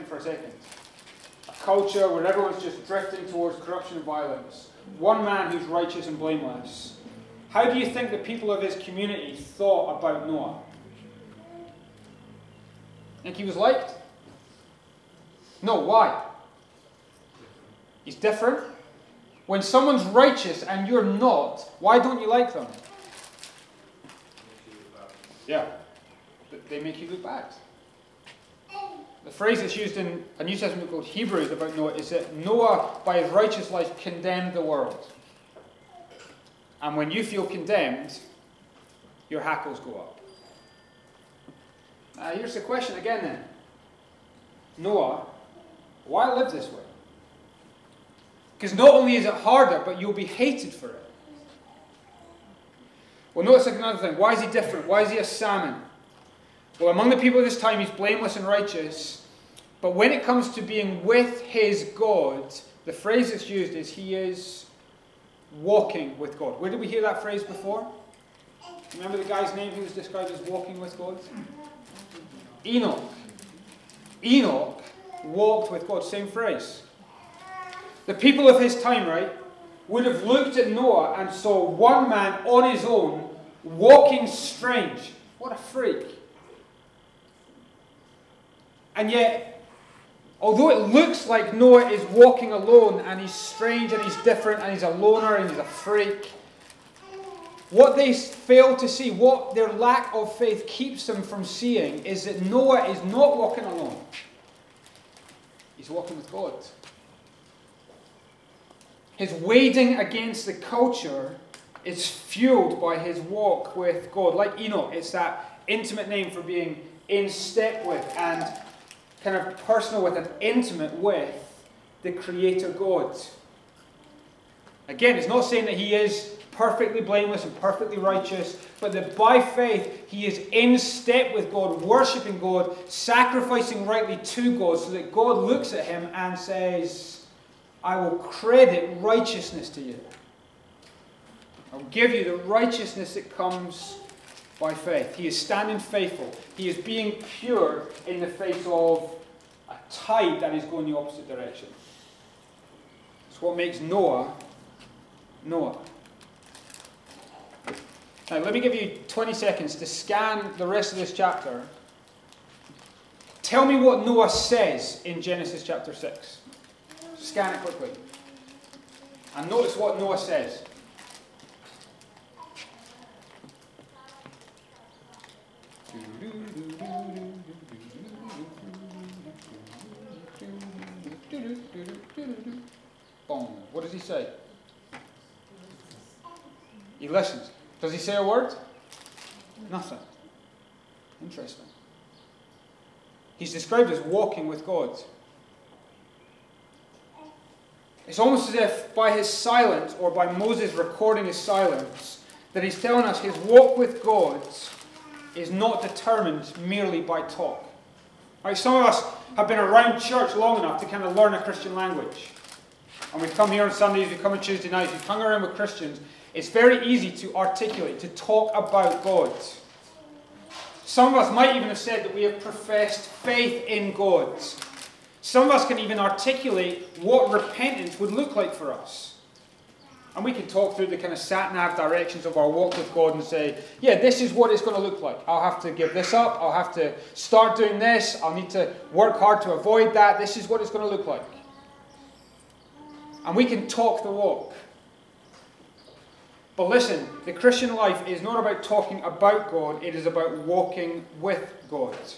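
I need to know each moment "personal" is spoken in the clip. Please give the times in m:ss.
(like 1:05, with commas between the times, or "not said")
1:59.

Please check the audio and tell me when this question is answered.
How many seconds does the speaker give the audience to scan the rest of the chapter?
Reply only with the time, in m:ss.
2:39.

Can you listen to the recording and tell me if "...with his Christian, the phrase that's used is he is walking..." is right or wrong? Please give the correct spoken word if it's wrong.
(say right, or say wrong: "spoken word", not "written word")
wrong: "God", not "Christian".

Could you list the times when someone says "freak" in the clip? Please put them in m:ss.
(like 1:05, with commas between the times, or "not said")
1:25, 1:35.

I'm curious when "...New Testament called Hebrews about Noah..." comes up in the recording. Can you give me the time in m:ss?
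0:30.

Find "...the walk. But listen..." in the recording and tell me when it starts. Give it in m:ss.
4:04.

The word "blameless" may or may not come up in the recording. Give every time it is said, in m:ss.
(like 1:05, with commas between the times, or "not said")
0:06, 0:57, 2:06.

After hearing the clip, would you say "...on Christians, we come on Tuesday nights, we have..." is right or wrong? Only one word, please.
wrong.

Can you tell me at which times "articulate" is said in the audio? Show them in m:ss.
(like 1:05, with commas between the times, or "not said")
3:37, 3:45.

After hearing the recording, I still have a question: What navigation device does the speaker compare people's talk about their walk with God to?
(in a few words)
sat nav.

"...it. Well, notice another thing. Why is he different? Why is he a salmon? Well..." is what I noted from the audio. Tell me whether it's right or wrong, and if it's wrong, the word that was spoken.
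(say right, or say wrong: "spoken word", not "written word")
right.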